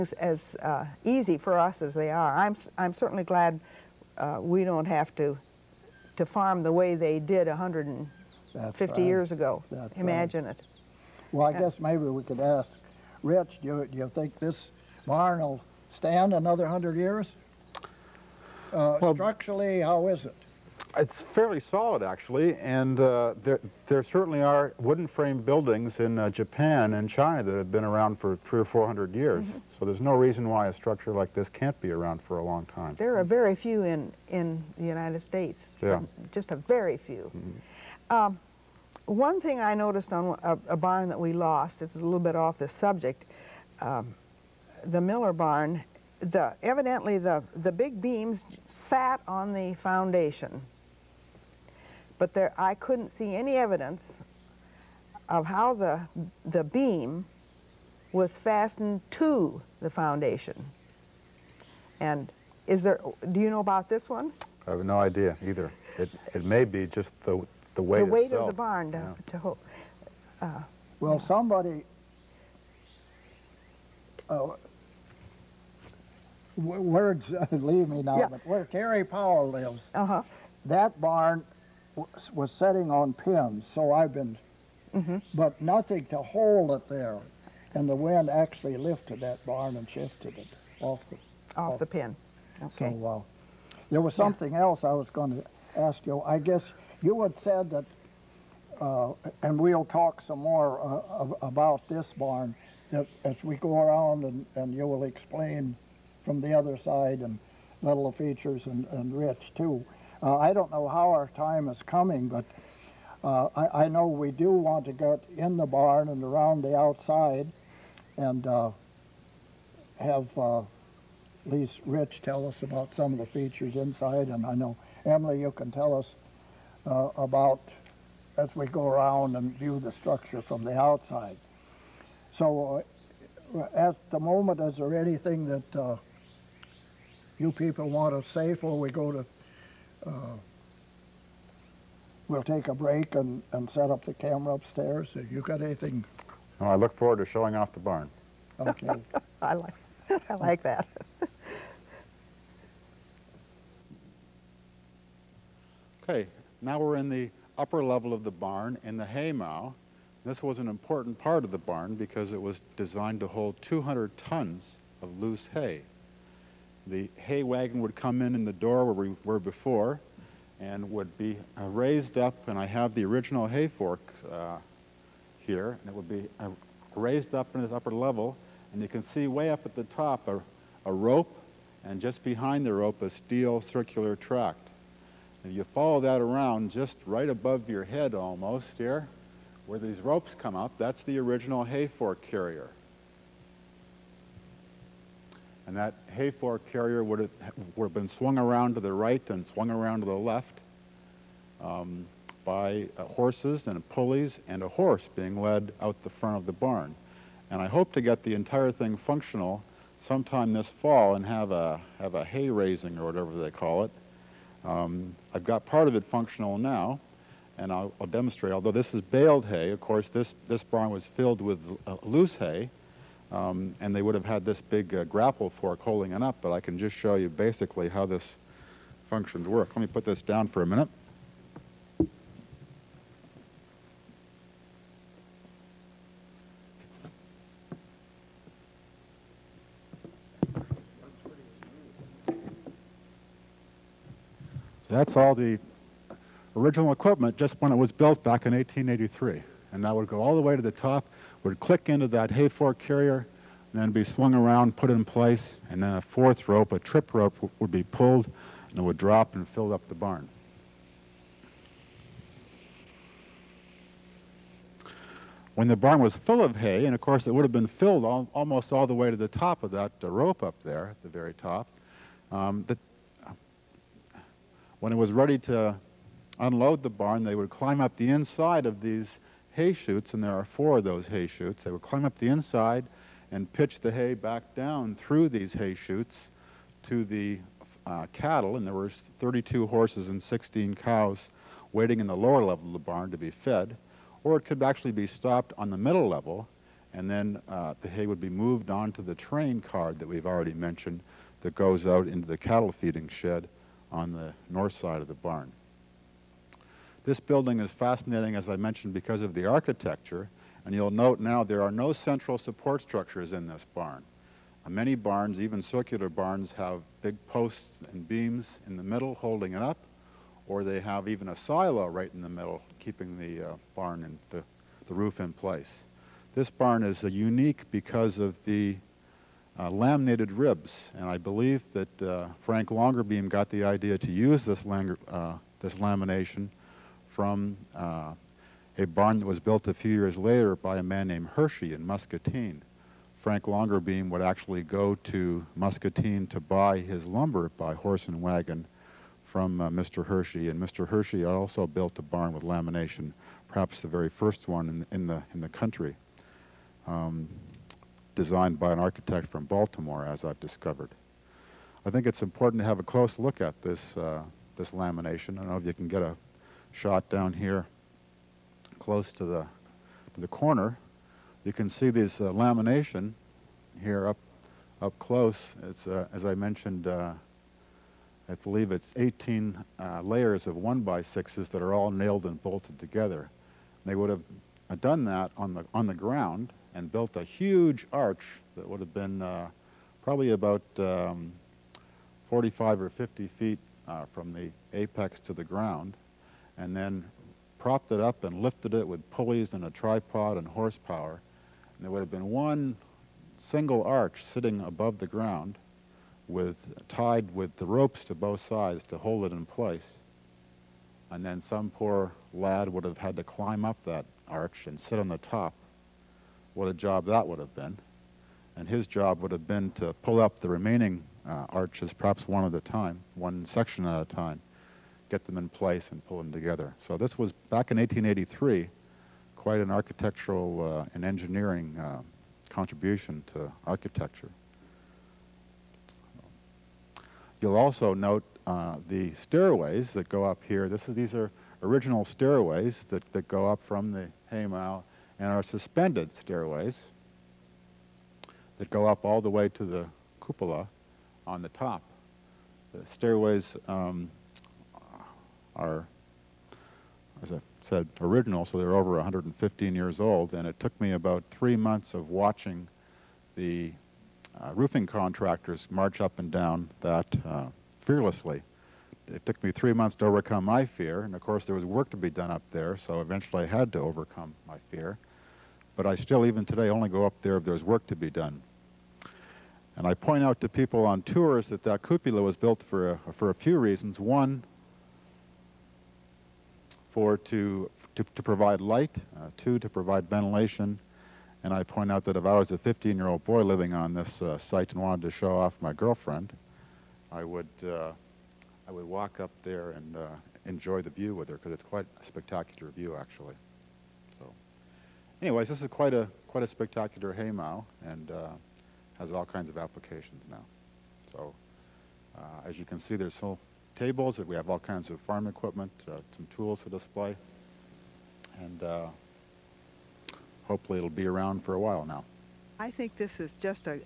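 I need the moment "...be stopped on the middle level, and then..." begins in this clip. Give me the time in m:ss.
4:54.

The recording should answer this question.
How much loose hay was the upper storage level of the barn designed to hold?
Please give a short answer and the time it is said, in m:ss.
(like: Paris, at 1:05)
200 tons, at 2:43.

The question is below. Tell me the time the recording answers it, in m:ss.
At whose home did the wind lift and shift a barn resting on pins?
1:18.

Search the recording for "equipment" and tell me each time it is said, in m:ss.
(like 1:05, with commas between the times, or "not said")
4:06, 8:35.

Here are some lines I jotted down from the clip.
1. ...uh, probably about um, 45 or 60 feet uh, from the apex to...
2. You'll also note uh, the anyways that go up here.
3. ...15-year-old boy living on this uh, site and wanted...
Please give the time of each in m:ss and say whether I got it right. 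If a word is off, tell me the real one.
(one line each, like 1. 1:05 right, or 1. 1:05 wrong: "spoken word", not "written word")
1. 6:29 wrong: "50", not "60"
2. 7:17 wrong: "stairways", not "anyways"
3. 8:12 right.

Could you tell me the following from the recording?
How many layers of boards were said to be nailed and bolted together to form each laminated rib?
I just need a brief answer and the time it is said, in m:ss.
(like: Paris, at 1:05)
18, at 6:18.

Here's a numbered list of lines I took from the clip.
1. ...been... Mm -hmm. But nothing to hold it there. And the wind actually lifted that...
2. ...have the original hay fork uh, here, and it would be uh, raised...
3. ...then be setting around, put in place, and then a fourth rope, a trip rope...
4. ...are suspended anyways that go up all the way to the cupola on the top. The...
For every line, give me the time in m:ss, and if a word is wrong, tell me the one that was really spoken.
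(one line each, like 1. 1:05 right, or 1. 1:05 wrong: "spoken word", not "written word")
1. 1:24 right
2. 2:52 right
3. 4:13 wrong: "swung", not "setting"
4. 7:25 wrong: "stairways", not "anyways".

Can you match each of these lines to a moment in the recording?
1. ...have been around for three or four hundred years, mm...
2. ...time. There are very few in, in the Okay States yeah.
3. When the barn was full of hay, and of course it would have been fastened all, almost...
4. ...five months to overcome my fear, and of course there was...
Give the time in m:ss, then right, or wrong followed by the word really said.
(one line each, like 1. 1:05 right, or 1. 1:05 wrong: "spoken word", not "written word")
1. 0:27 right
2. 0:32 wrong: "United", not "Okay"
3. 4:25 wrong: "filled", not "fastened"
4. 7:49 wrong: "three", not "five".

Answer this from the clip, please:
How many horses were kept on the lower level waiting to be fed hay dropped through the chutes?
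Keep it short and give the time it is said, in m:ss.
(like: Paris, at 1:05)
32, at 4:48.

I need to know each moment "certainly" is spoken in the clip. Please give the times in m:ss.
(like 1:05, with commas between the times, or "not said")
0:02, 0:24.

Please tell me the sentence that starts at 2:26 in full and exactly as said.
I look forward to showing off the barn.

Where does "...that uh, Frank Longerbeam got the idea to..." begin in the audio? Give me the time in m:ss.
5:31.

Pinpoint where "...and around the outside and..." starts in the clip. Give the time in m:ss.
1:56.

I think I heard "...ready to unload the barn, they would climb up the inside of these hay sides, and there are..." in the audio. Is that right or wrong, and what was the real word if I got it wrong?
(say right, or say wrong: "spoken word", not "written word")
wrong: "chutes", not "sides".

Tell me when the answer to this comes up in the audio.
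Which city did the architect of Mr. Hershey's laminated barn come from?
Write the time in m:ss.
5:59.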